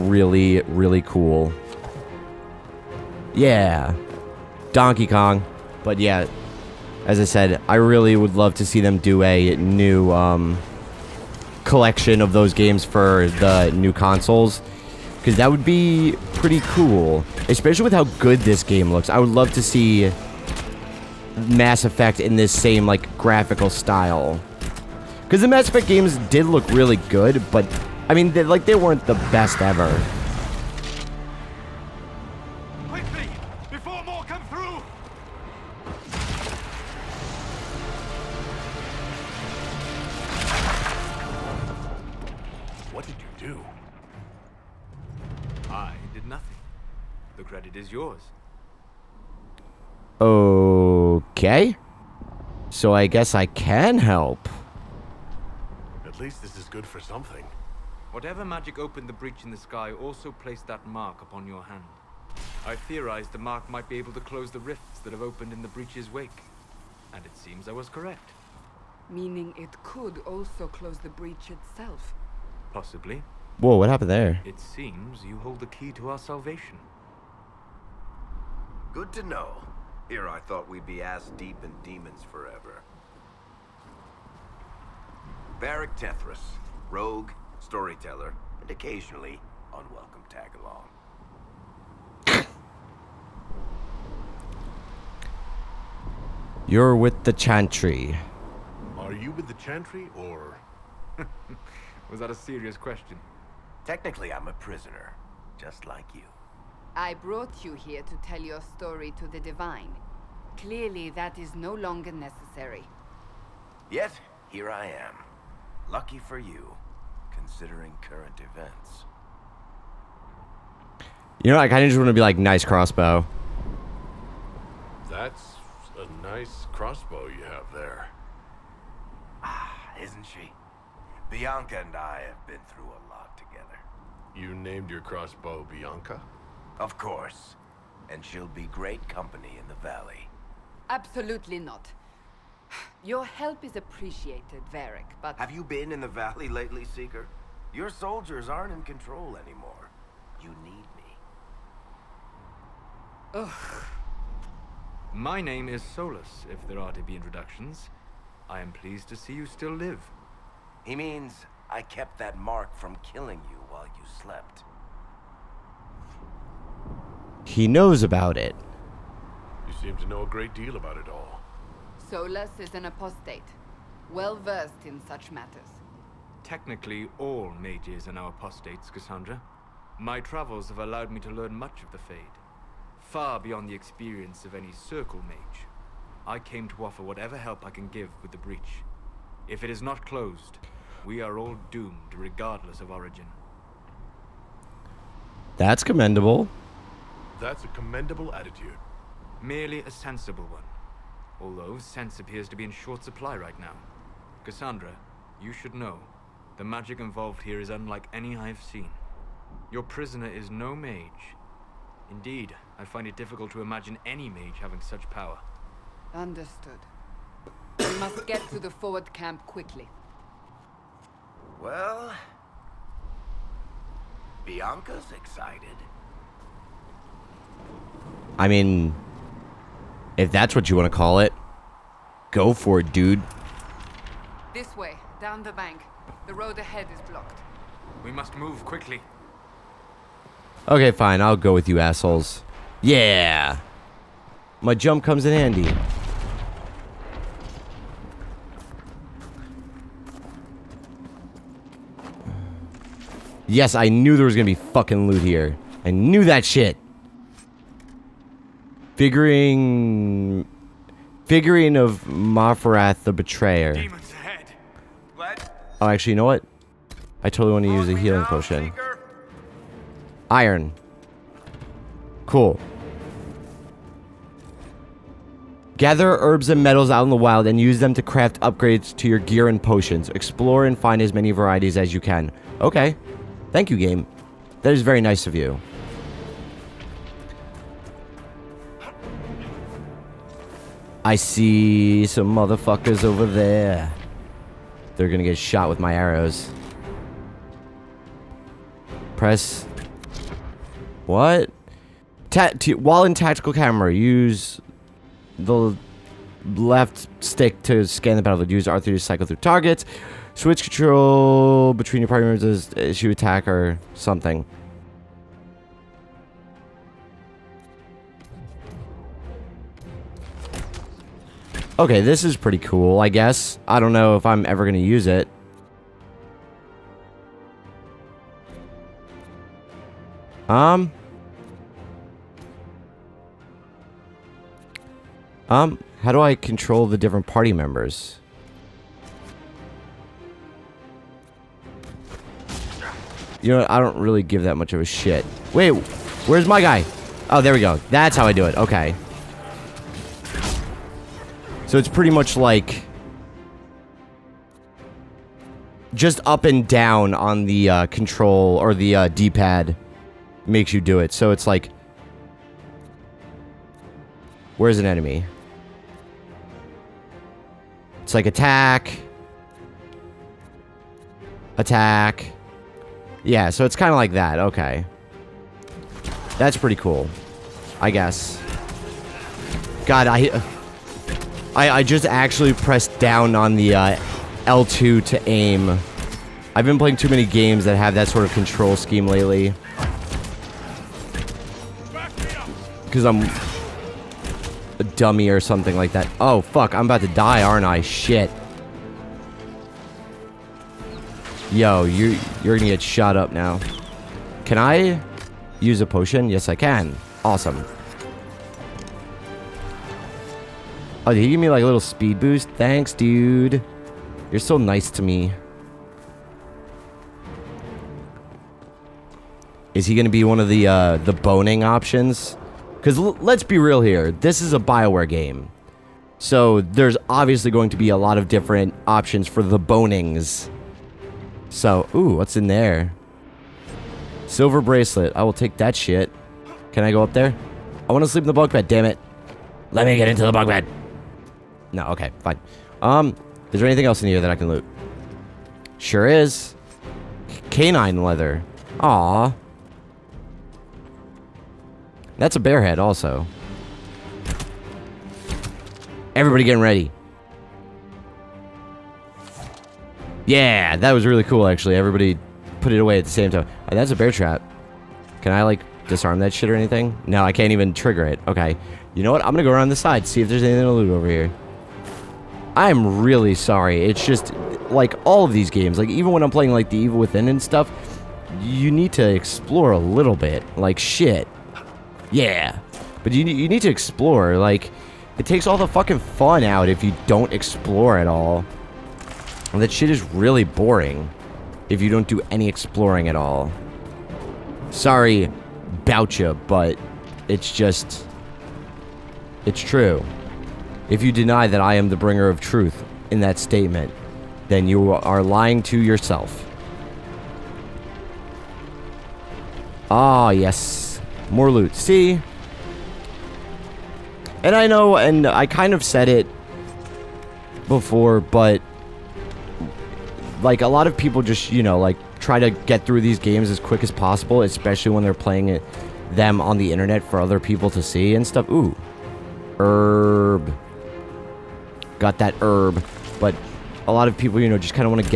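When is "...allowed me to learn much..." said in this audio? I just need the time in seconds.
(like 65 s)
180 s.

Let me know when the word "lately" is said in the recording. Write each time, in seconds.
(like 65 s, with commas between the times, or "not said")
146 s, 389 s.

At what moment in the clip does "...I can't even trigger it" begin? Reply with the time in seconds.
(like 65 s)
467 s.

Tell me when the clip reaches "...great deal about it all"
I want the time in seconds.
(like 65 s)
170 s.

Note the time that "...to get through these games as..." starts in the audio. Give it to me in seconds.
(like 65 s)
522 s.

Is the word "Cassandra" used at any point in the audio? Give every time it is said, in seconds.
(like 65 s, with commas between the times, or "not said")
178 s, 204 s.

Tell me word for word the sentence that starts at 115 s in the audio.
Lucky for you, considering current events.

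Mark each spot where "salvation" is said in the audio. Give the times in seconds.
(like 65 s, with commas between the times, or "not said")
76 s.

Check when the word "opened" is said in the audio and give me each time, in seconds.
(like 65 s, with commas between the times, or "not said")
58 s, 65 s.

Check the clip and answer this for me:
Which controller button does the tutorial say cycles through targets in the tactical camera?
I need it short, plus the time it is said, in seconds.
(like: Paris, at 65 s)
R3, at 308 s.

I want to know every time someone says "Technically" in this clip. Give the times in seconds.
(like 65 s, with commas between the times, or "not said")
103 s, 176 s.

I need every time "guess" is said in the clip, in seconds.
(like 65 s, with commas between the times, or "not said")
53 s, 323 s, 377 s.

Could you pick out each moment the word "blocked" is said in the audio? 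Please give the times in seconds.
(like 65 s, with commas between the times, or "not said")
237 s.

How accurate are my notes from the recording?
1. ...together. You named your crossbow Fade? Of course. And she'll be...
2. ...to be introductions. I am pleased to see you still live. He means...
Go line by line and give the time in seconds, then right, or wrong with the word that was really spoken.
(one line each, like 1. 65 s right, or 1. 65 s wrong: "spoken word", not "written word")
1. 133 s wrong: "Bianca", not "Fade"
2. 156 s right.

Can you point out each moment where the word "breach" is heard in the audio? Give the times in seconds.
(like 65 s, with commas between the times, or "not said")
59 s, 65 s, 71 s, 188 s.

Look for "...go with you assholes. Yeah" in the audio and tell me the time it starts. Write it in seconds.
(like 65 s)
241 s.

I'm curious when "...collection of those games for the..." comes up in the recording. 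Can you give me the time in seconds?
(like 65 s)
11 s.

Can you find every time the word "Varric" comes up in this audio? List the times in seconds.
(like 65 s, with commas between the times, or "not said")
85 s, 144 s.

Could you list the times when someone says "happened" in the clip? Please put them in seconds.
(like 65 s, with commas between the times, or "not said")
73 s.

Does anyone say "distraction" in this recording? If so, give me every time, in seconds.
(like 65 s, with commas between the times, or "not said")
not said.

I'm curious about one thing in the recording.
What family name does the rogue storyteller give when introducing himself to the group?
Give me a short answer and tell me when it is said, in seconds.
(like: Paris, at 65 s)
Tethras, at 85 s.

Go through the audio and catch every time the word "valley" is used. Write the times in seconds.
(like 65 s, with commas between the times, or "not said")
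139 s, 146 s.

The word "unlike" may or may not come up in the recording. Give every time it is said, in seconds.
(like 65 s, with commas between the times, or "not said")
207 s.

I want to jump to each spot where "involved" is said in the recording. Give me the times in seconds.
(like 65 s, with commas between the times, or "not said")
206 s.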